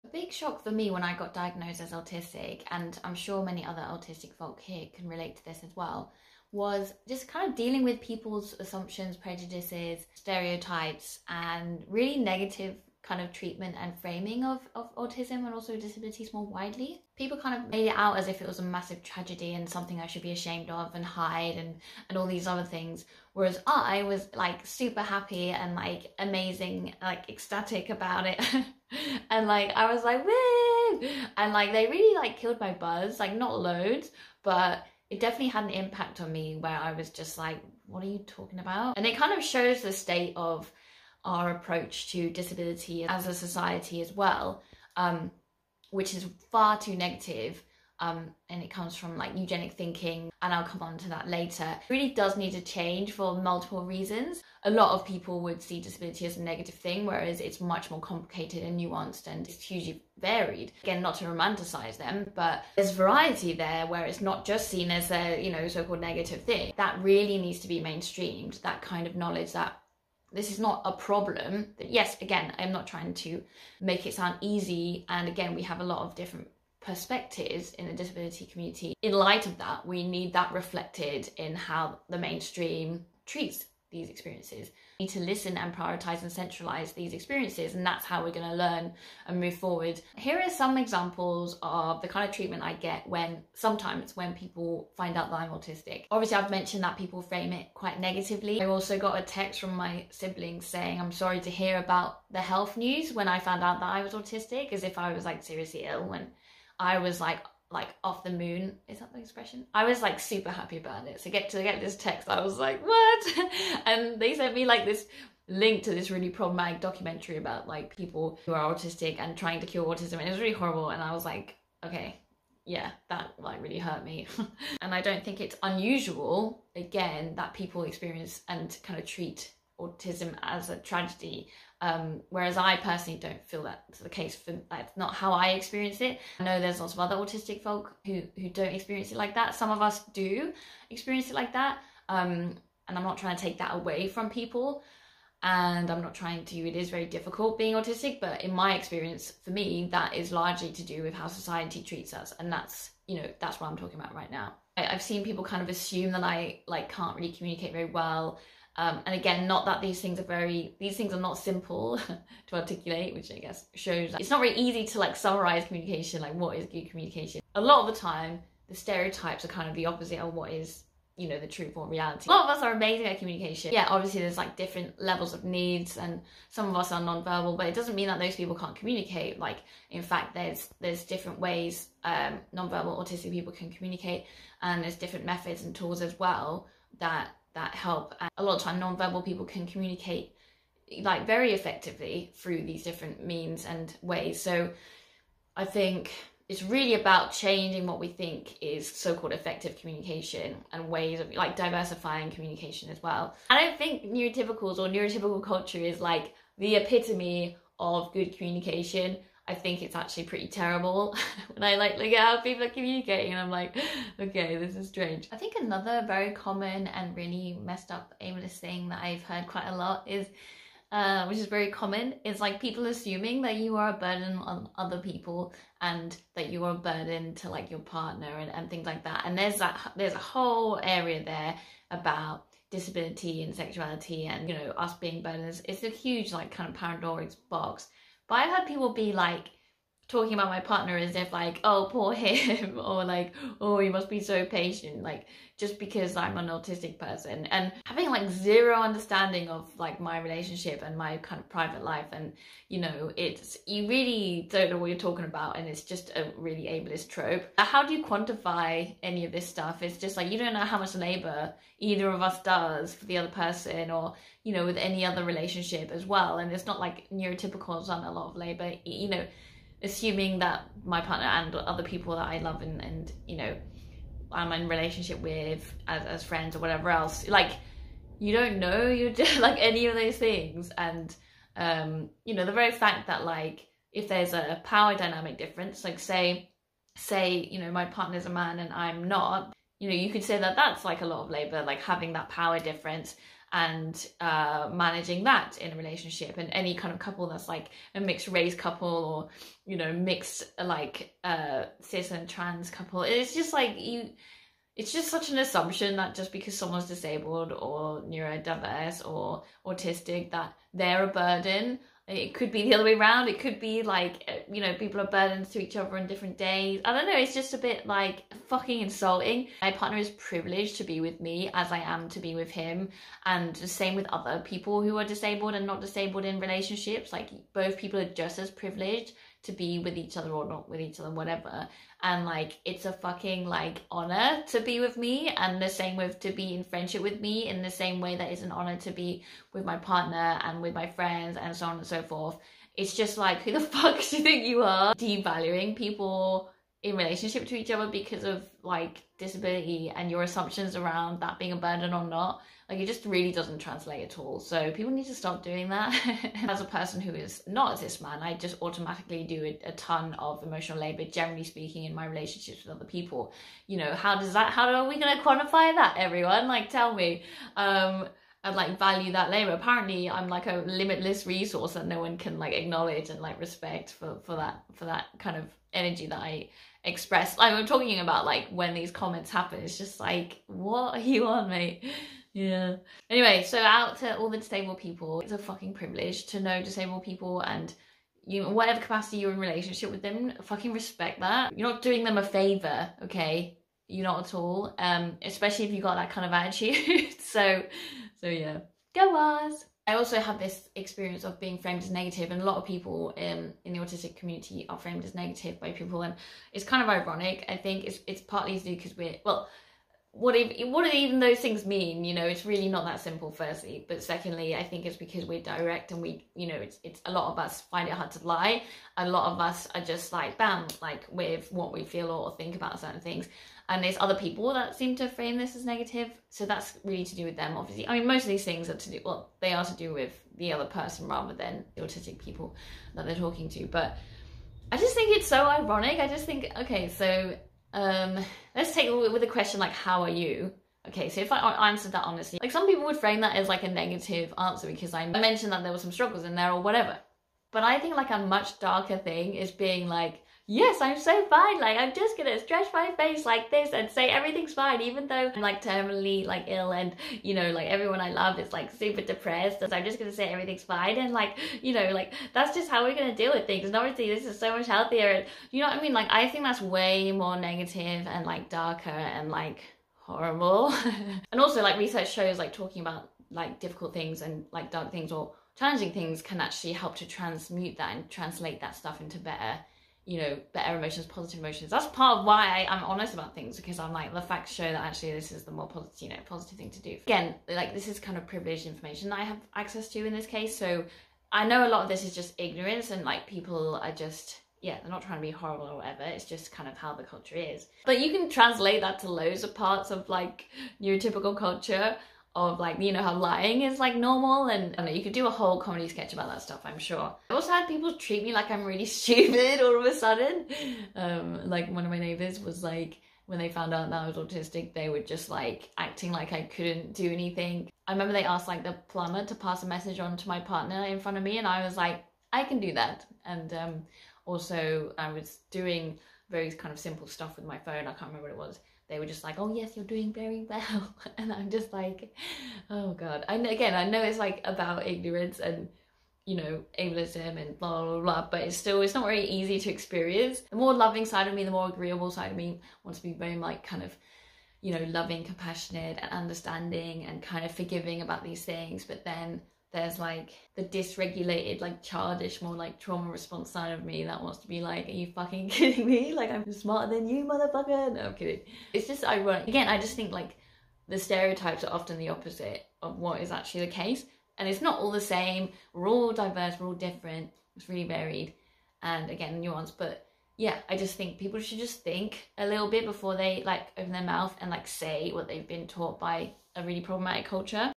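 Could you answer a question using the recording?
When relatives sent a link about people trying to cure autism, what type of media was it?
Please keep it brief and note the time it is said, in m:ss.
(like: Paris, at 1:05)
documentary, at 1:56.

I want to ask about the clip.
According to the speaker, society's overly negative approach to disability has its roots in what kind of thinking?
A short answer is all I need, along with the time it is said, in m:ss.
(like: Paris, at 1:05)
eugenic thinking, at 0:49.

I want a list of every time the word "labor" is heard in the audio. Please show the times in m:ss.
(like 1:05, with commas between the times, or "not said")
4:20, 4:28, 4:51, 6:00, 6:09.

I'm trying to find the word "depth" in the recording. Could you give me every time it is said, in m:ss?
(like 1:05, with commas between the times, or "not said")
not said.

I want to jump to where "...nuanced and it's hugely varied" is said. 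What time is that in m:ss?
0:58.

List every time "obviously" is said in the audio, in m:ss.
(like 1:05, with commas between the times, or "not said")
1:36, 2:53, 7:07, 7:43.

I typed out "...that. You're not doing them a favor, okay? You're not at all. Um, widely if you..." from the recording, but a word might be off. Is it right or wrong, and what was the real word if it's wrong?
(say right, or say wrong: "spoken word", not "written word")
wrong: "especially", not "widely".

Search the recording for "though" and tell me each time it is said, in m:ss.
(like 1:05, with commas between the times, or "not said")
7:35.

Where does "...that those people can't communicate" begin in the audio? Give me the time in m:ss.
2:58.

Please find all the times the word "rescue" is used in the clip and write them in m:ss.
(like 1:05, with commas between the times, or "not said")
not said.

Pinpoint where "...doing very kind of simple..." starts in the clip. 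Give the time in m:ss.
8:45.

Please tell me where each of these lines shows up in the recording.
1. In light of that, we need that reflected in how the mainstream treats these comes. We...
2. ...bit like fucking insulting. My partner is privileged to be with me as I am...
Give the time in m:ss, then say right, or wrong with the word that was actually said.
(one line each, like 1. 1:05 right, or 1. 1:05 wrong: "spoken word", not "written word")
1. 1:19 wrong: "experiences", not "comes"
2. 5:17 right.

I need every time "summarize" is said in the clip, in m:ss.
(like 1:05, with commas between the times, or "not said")
2:45.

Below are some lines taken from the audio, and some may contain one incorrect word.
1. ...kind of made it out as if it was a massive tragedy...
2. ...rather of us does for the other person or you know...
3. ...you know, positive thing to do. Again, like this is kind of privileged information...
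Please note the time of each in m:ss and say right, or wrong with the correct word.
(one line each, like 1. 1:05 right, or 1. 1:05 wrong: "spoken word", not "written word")
1. 0:17 right
2. 4:21 wrong: "either", not "rather"
3. 8:06 right.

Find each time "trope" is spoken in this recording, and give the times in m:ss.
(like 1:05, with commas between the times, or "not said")
4:17.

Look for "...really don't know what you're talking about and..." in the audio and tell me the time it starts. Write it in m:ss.
4:13.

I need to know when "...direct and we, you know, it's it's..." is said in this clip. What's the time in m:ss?
6:55.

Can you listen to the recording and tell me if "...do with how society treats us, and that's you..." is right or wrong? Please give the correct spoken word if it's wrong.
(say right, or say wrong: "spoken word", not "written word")
right.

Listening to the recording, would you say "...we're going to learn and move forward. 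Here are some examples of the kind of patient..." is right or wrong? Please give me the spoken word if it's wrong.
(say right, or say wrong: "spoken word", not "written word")
wrong: "treatment", not "patient".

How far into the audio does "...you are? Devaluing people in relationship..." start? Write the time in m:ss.
5:44.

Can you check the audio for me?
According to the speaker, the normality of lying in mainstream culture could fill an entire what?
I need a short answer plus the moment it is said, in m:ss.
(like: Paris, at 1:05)
comedy sketch, at 8:25.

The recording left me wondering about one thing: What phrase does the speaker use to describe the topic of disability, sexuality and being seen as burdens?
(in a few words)
Pandora's box.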